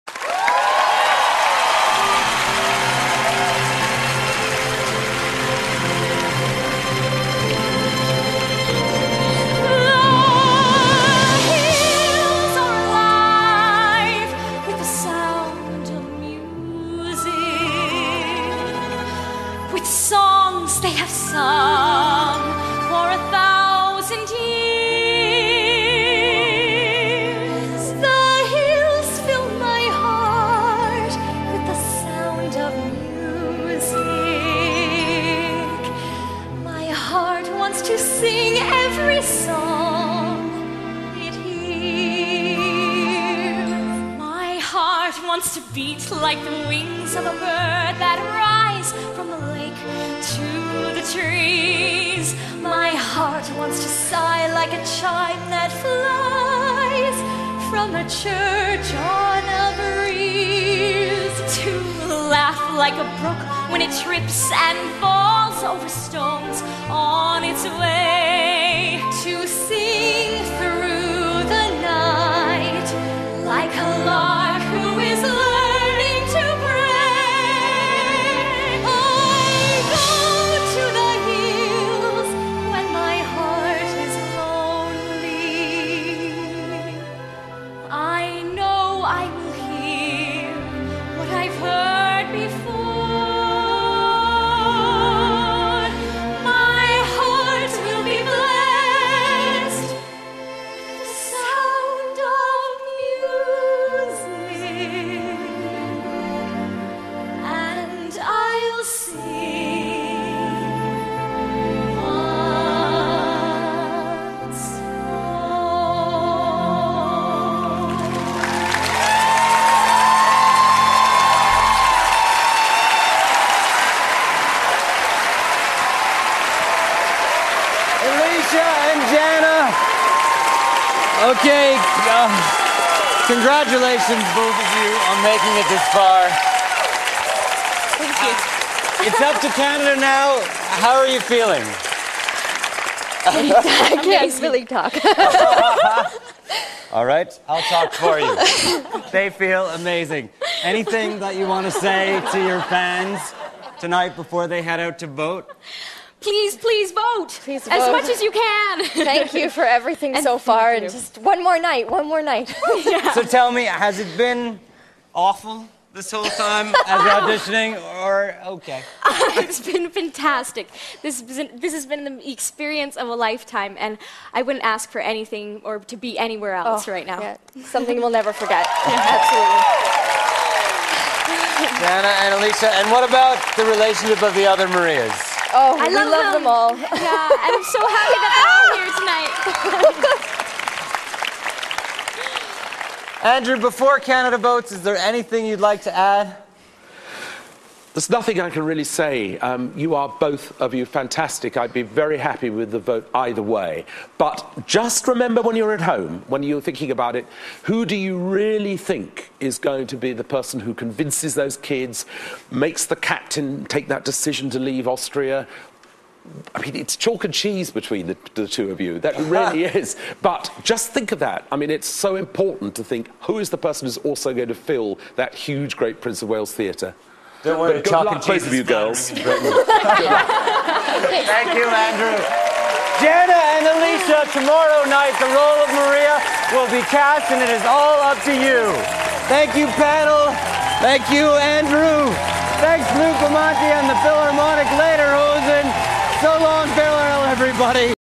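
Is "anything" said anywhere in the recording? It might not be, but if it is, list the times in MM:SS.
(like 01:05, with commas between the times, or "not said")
02:30, 02:55, 03:14.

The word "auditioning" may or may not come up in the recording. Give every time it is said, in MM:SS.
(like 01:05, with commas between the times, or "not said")
02:47.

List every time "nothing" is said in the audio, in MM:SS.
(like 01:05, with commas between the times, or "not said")
03:18.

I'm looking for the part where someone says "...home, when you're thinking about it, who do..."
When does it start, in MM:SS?
03:25.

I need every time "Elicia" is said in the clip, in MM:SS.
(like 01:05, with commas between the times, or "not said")
03:02, 03:53.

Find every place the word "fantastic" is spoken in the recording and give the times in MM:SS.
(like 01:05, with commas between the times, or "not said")
02:49, 03:20.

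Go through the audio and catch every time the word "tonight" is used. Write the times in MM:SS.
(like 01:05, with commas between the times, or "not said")
02:33, 03:10.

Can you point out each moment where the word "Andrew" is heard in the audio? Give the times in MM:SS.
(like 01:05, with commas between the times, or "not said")
03:13, 03:51, 04:01.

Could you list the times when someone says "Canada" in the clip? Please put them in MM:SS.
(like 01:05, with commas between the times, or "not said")
02:19, 03:13.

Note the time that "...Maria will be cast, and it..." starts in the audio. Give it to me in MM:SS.
03:55.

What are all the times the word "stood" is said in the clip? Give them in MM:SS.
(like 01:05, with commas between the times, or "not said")
not said.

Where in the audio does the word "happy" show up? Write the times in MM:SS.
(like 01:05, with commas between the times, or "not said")
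03:07, 03:22.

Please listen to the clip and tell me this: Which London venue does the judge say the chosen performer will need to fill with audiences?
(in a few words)
Prince of Wales Theatre.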